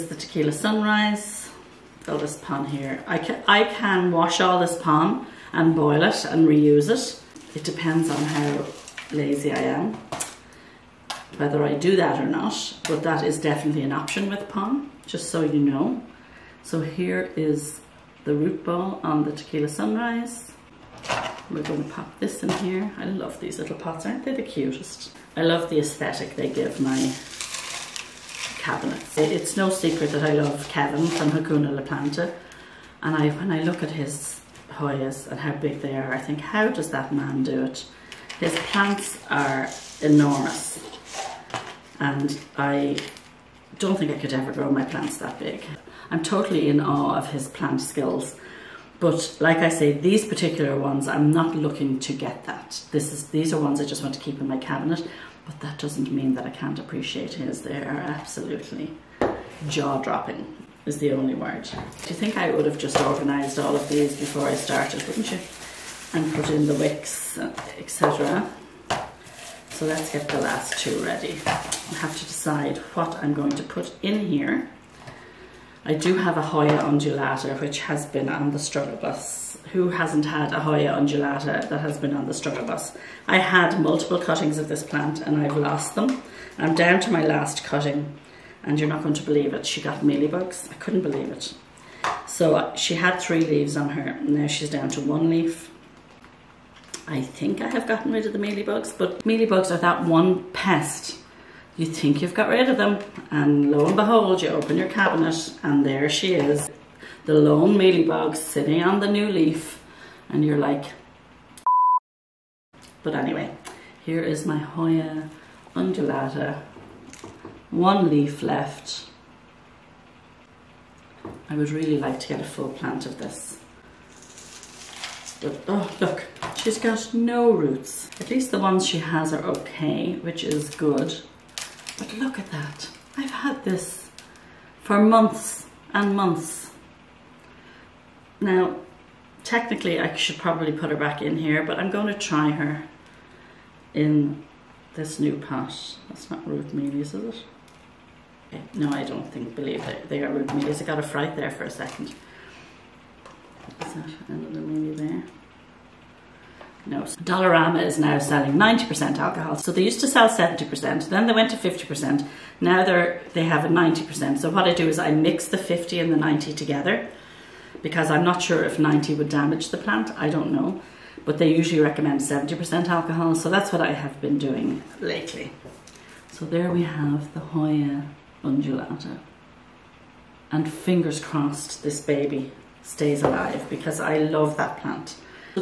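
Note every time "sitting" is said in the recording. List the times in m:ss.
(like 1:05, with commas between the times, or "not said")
1:48.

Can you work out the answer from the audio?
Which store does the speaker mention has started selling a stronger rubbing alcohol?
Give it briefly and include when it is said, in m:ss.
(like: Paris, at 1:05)
Dollarama, at 2:37.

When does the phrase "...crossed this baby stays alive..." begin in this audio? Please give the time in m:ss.
3:01.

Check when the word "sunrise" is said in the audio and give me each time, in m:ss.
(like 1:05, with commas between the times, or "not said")
0:00, 0:19.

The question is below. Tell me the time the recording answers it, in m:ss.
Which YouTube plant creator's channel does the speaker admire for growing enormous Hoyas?
0:31.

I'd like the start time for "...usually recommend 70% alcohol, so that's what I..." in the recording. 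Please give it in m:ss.
2:51.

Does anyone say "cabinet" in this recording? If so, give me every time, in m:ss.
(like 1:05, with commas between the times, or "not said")
0:28, 0:54, 1:44.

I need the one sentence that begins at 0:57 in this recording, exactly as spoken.
They are absolutely jaw-dropping is the only word.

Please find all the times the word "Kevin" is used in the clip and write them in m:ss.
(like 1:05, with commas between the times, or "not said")
0:30.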